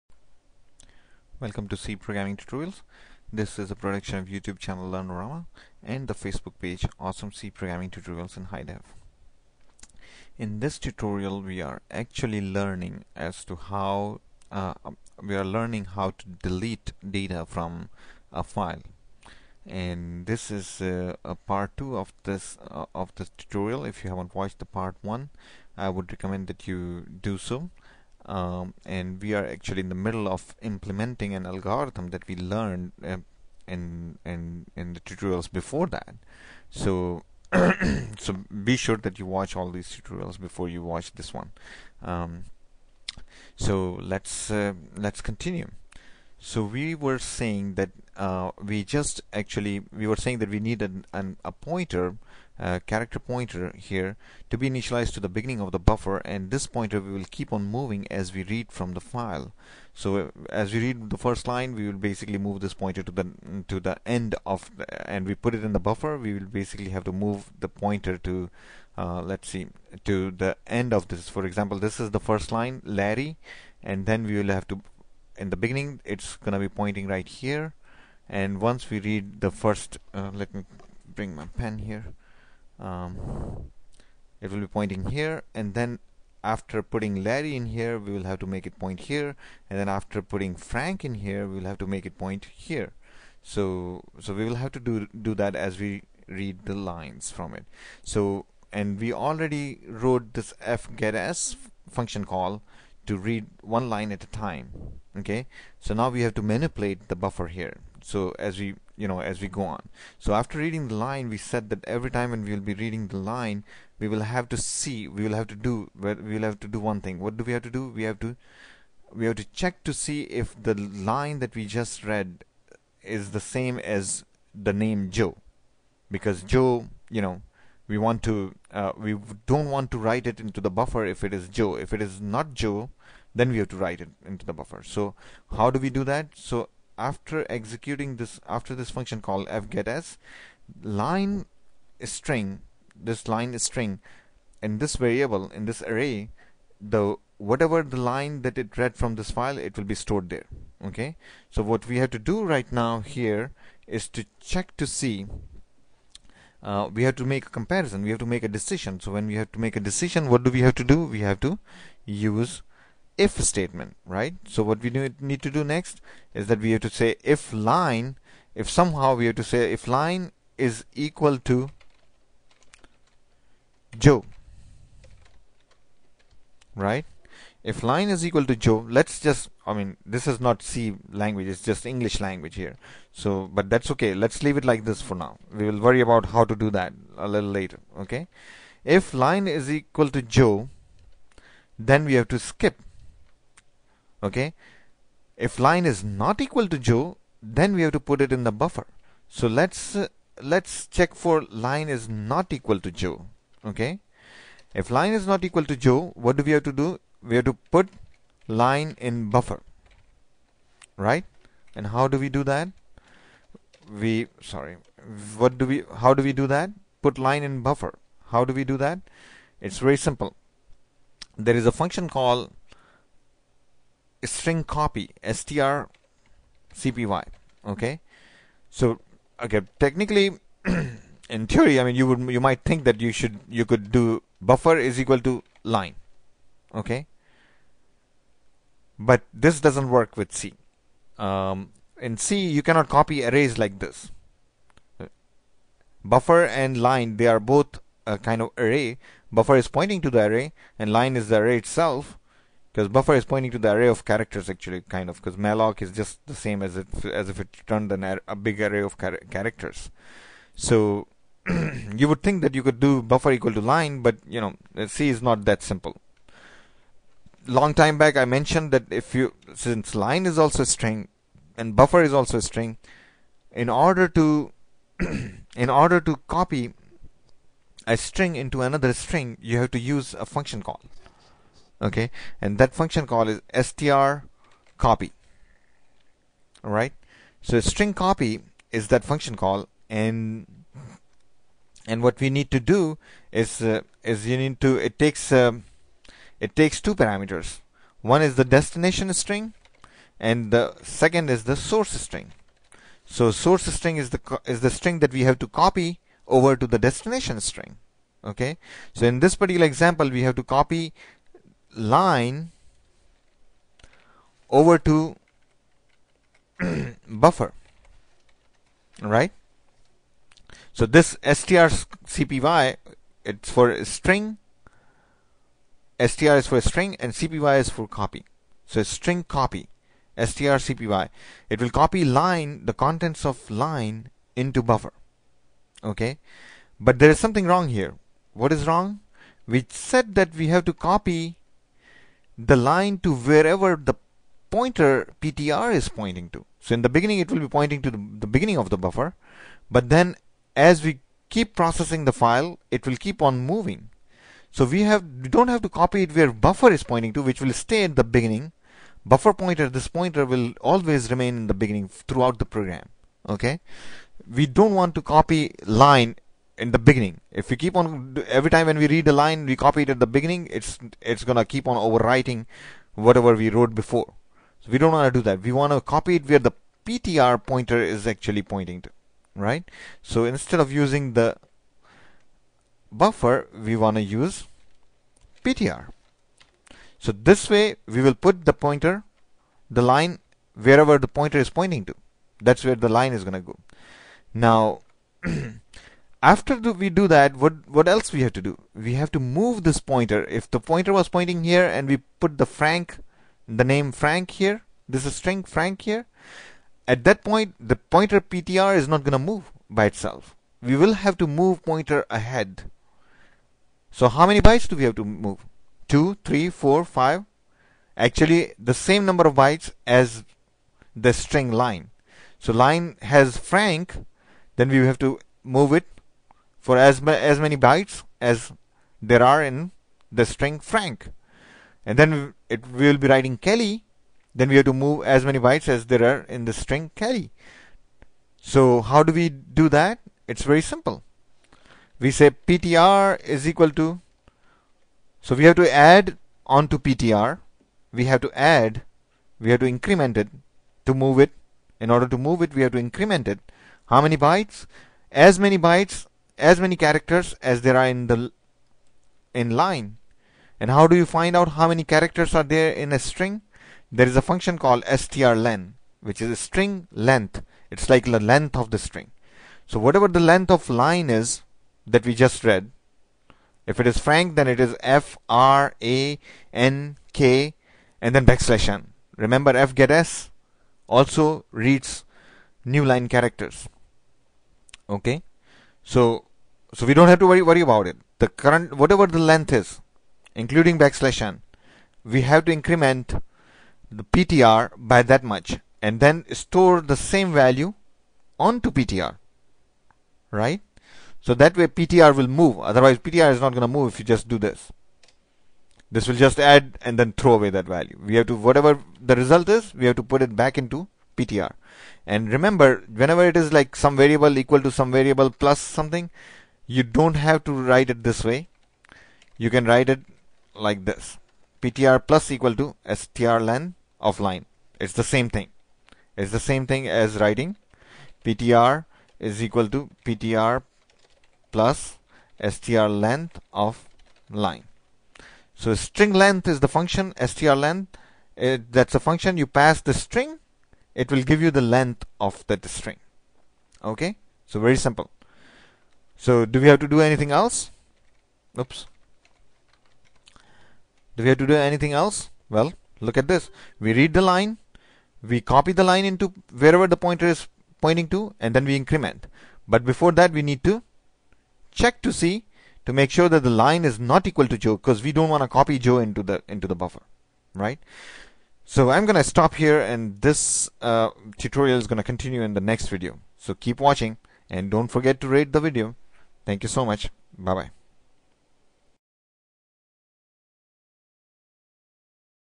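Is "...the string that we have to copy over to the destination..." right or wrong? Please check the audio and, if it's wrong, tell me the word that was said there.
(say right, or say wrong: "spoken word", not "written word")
right.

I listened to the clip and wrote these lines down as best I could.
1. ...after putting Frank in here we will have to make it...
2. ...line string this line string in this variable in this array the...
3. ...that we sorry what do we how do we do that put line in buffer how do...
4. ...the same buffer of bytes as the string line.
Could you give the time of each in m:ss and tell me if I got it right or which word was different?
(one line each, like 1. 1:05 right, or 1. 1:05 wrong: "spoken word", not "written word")
1. 1:29 right
2. 2:21 right
3. 3:32 right
4. 6:58 wrong: "number", not "buffer".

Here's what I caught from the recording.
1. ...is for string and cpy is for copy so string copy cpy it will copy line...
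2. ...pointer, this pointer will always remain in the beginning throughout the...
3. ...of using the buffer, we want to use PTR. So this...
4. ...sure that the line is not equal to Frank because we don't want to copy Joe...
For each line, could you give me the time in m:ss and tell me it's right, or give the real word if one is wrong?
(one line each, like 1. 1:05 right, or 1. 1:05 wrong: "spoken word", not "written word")
1. 5:26 right
2. 5:59 right
3. 6:20 right
4. 9:23 wrong: "Joe", not "Frank".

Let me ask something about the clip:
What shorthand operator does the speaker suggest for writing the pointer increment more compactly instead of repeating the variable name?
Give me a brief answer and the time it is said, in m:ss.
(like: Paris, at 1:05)
plus equal, at 8:42.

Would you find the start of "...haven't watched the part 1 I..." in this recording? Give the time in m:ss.
0:24.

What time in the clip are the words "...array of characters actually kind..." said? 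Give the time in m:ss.
4:13.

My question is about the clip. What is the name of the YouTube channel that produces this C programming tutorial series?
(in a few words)
Learnorama.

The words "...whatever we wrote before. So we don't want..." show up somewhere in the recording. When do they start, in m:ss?
6:13.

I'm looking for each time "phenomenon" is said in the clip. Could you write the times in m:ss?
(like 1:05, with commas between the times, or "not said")
not said.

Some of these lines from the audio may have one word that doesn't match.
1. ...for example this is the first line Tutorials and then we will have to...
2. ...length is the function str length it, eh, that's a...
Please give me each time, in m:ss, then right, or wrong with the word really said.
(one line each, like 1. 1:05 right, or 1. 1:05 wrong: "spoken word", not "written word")
1. 1:11 wrong: "Larry", not "Tutorials"
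2. 8:56 right.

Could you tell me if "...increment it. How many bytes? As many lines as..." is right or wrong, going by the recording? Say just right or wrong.
wrong.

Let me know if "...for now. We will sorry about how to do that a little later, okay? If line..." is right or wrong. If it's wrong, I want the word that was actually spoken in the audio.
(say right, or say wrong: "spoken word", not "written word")
wrong: "worry", not "sorry".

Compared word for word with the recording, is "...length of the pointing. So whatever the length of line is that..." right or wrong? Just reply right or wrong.
wrong.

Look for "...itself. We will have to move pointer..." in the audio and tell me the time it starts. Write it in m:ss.
6:49.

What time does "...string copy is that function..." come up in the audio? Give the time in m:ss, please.
4:47.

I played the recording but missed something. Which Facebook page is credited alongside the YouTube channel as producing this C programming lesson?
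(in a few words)
Awesome C Programming Tutorials in HD.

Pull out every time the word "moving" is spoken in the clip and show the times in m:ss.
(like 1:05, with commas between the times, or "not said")
0:57, 5:53.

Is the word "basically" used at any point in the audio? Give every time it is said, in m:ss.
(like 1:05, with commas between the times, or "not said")
1:01, 1:06.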